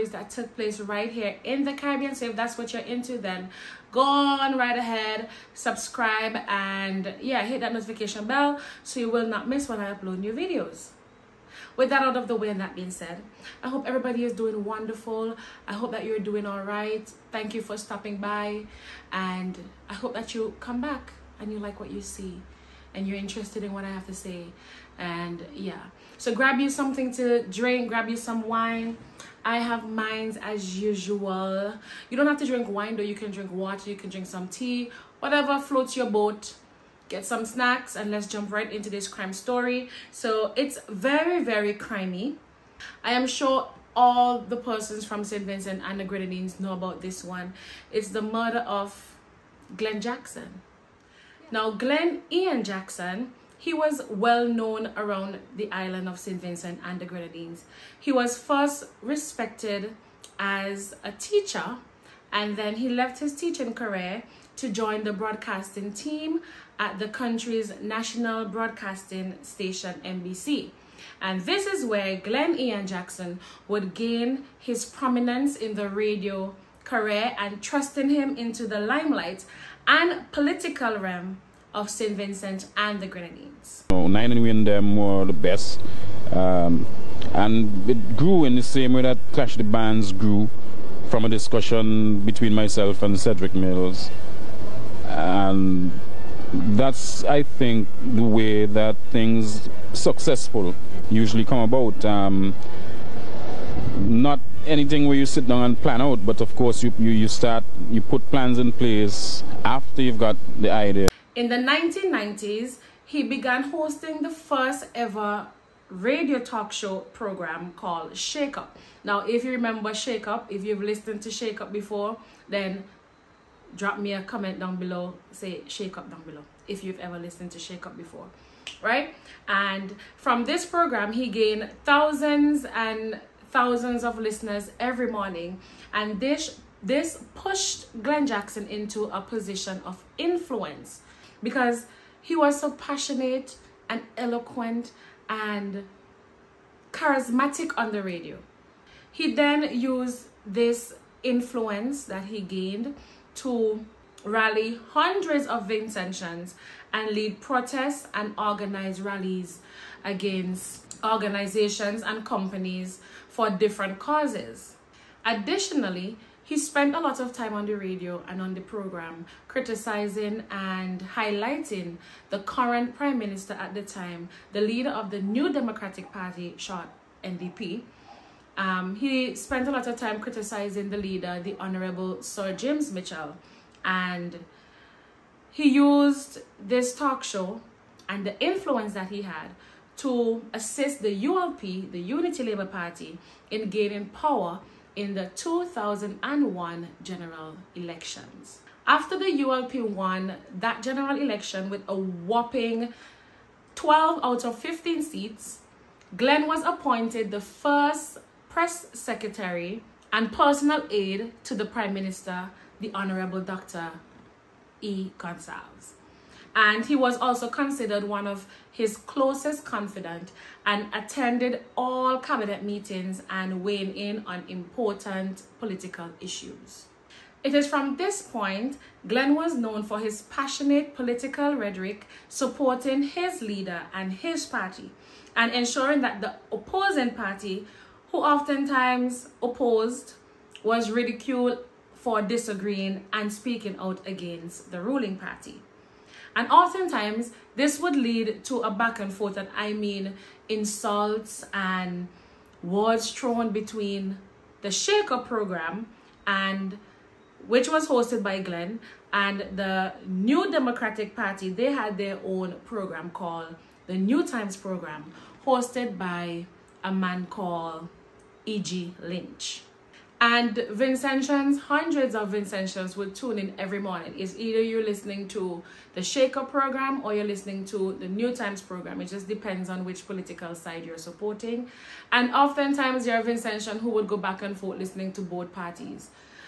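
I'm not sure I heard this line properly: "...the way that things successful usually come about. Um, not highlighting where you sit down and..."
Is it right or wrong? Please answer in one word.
wrong.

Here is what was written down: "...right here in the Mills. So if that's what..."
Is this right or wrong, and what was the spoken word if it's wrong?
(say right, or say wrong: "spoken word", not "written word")
wrong: "Caribbean", not "Mills".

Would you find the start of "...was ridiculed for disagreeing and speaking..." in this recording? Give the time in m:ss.
4:00.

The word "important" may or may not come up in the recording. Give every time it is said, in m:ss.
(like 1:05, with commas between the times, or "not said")
3:44.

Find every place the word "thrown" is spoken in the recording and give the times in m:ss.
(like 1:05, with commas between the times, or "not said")
4:13.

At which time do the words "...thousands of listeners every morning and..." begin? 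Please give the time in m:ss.
2:13.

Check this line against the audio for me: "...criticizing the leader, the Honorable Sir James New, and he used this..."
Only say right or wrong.
wrong.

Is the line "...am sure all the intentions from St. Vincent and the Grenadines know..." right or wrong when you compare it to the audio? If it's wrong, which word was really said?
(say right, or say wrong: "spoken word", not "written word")
wrong: "persons", not "intentions".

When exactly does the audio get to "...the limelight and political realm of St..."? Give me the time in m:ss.
1:18.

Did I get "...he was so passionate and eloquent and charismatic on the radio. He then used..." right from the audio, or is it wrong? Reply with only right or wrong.
right.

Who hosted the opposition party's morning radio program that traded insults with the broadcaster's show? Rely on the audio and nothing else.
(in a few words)
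E.G. Lynch.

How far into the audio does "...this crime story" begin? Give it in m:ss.
0:38.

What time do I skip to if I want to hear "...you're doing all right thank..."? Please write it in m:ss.
0:16.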